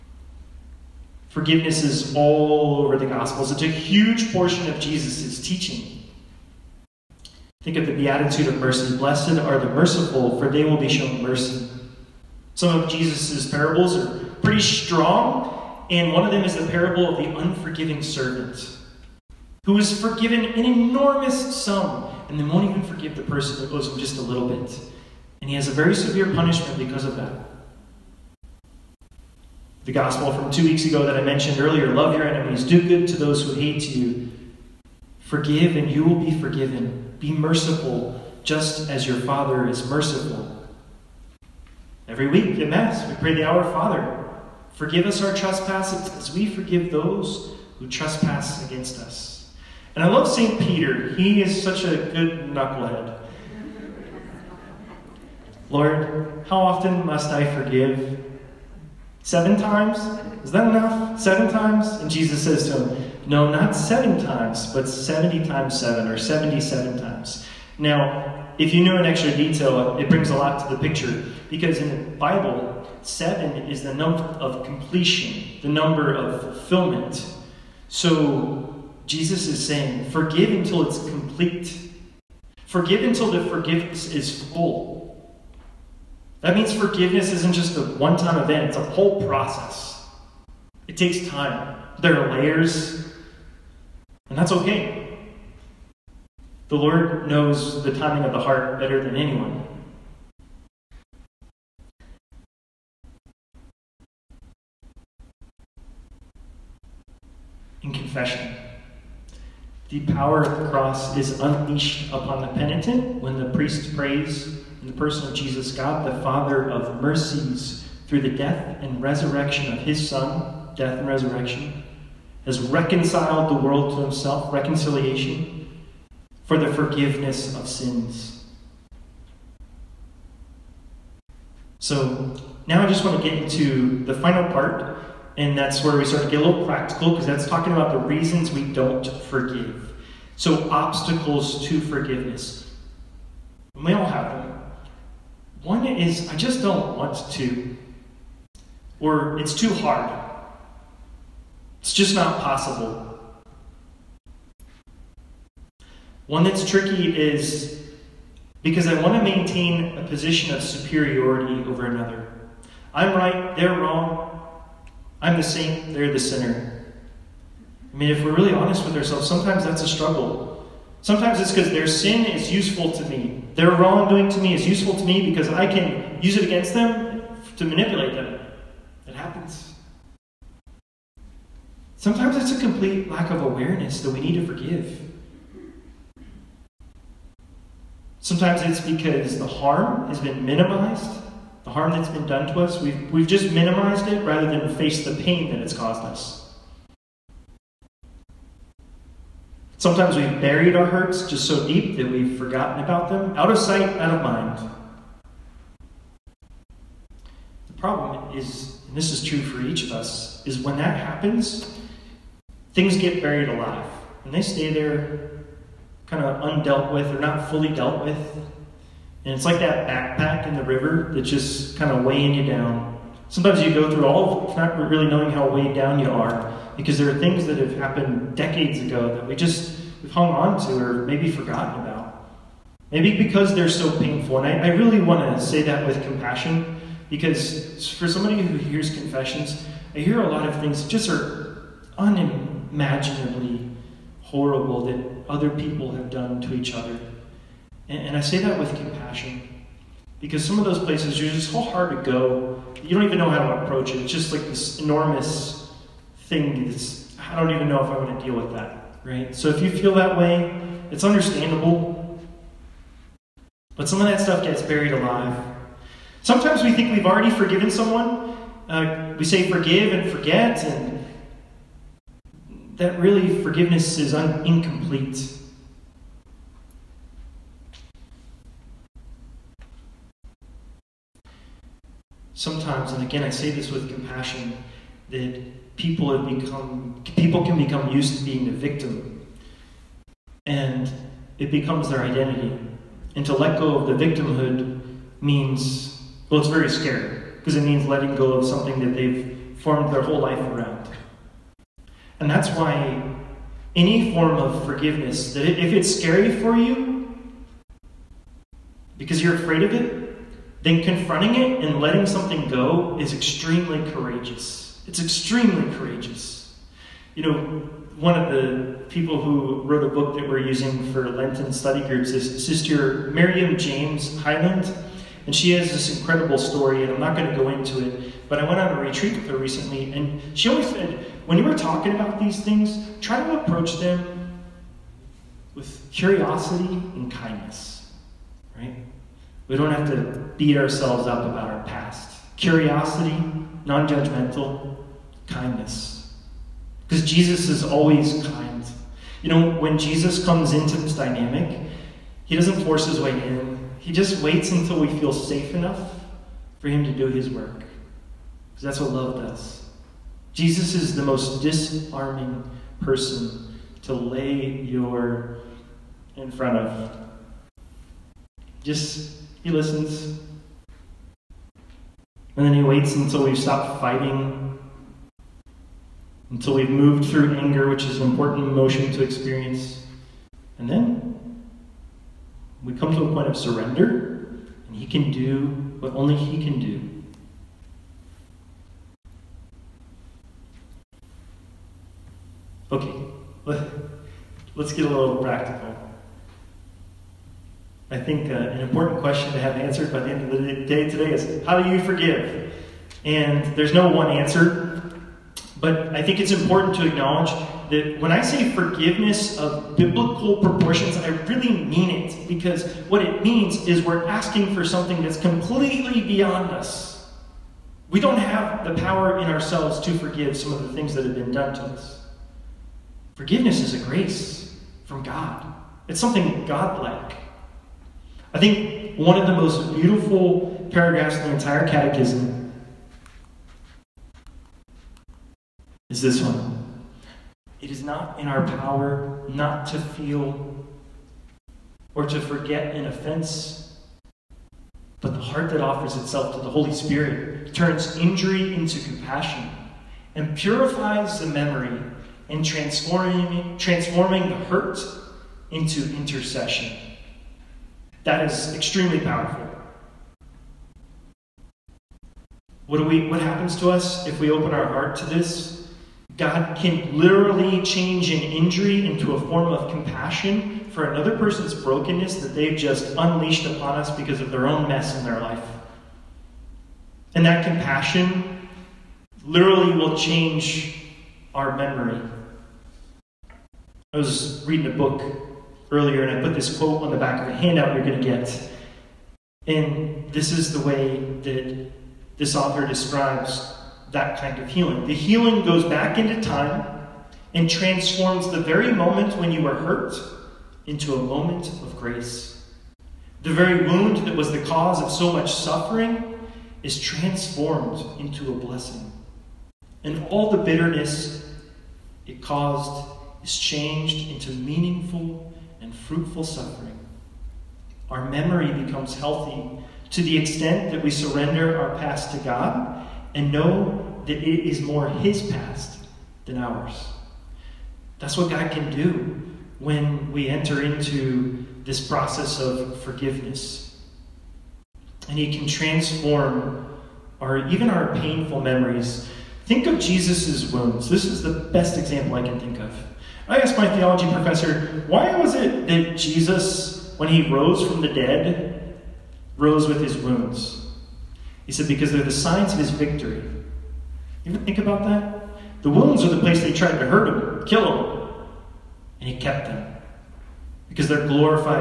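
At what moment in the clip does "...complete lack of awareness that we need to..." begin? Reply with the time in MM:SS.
03:02.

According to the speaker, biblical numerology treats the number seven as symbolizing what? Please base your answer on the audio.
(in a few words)
completion.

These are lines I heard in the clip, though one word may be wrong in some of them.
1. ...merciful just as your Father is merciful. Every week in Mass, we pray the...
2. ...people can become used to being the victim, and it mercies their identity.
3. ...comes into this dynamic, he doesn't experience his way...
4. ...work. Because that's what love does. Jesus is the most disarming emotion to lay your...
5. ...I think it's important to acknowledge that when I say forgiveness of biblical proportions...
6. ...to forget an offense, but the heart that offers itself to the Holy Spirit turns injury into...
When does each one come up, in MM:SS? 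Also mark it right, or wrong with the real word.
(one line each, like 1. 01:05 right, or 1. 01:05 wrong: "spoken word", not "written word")
1. 00:37 right
2. 04:47 wrong: "becomes", not "mercies"
3. 05:50 wrong: "force", not "experience"
4. 05:57 wrong: "person", not "emotion"
5. 06:45 right
6. 07:22 right.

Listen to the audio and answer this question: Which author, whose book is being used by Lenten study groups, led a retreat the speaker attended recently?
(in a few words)
Sister Miriam James Heidland.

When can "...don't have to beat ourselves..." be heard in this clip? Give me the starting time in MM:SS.
05:39.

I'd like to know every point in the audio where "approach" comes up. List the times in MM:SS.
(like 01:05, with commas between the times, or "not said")
04:13, 05:33.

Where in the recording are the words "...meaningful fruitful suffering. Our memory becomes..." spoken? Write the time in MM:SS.
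08:34.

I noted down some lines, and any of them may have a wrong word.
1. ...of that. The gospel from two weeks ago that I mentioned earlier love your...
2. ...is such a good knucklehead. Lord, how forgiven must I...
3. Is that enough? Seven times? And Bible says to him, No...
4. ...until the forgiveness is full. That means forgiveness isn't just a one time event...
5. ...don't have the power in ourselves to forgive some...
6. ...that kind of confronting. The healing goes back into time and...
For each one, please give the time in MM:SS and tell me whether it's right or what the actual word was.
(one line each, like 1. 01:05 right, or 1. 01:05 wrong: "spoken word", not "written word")
1. 00:27 right
2. 00:51 wrong: "often", not "forgiven"
3. 01:00 wrong: "Jesus", not "Bible"
4. 01:23 right
5. 06:57 right
6. 08:13 wrong: "healing", not "confronting".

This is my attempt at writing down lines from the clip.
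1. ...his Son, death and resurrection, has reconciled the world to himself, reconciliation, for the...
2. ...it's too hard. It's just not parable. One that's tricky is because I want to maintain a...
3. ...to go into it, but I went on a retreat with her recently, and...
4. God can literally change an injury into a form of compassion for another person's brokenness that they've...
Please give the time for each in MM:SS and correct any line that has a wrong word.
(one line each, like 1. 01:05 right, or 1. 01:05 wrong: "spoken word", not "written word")
1. 01:59 right
2. 02:29 wrong: "possible", not "parable"
3. 05:27 right
4. 07:46 right.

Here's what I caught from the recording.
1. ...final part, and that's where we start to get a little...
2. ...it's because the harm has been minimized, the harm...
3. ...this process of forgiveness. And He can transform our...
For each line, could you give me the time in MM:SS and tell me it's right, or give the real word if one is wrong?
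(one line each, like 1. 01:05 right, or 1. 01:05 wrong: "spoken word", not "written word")
1. 02:14 right
2. 03:08 right
3. 08:51 right.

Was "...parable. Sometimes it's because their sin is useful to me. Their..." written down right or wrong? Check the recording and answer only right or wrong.
wrong.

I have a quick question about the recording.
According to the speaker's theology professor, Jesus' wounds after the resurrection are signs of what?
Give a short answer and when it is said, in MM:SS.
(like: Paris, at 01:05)
his victory, at 09:12.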